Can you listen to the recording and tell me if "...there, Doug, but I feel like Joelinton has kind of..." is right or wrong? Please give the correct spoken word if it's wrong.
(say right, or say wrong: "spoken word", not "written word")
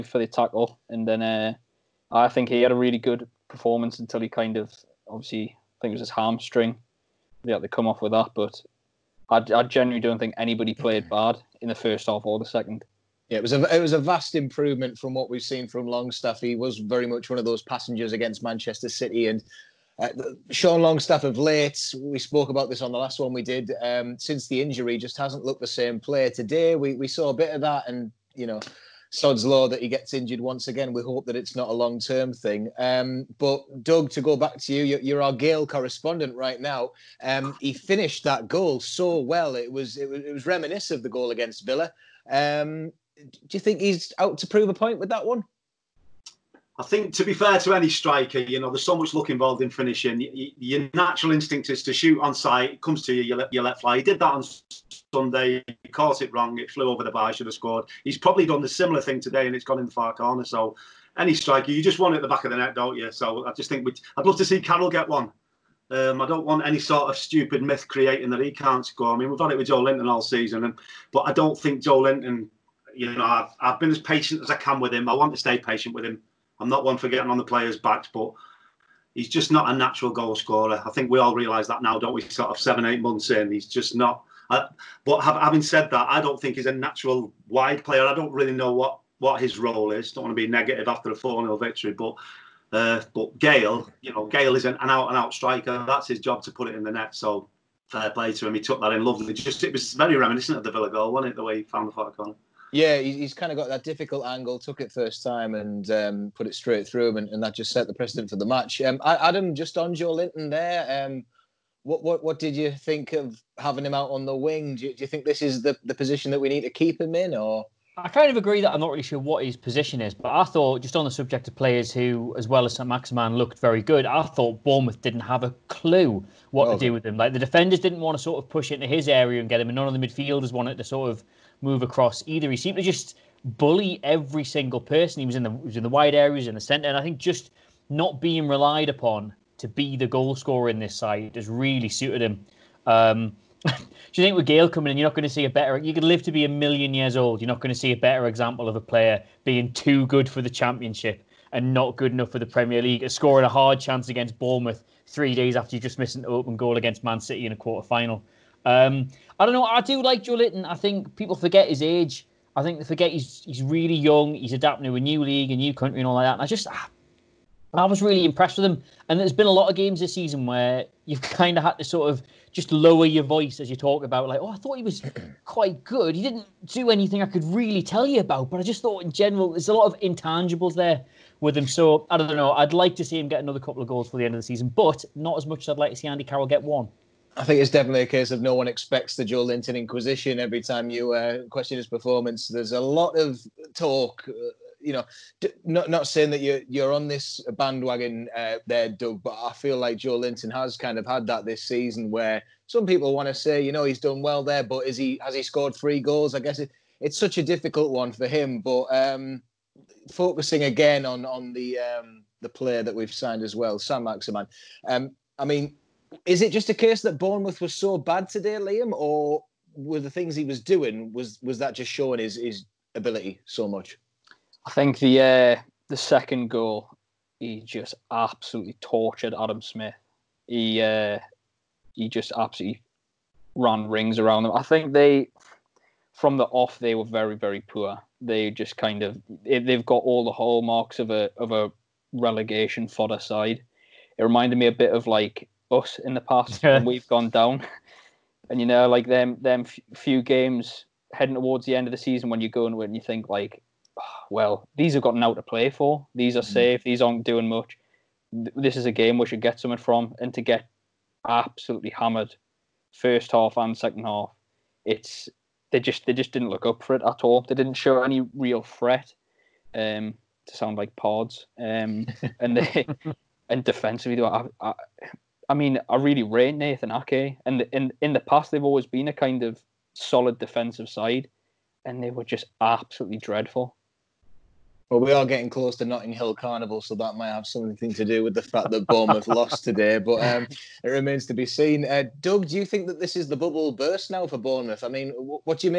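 right.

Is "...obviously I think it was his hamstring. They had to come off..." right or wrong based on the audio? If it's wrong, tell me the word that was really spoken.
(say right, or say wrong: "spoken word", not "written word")
right.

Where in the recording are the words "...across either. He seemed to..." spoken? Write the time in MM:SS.
02:11.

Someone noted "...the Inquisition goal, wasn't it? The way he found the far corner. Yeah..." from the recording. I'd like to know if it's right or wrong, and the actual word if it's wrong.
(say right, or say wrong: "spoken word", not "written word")
wrong: "Villa", not "Inquisition".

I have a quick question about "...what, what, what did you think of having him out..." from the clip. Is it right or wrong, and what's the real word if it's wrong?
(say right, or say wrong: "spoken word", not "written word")
right.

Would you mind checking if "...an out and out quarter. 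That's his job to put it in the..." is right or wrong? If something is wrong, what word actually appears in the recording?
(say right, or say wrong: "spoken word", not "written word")
wrong: "striker", not "quarter".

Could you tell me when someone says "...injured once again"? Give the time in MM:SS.
00:30.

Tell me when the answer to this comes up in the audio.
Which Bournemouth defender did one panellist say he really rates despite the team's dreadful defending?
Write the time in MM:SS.
04:36.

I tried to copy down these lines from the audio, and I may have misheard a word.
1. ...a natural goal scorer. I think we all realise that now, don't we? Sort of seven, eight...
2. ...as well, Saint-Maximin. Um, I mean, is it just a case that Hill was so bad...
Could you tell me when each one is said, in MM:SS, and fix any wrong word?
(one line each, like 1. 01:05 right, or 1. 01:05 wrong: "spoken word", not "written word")
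1. 01:19 right
2. 03:33 wrong: "Bournemouth", not "Hill".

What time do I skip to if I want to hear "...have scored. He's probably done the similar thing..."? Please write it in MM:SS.
00:57.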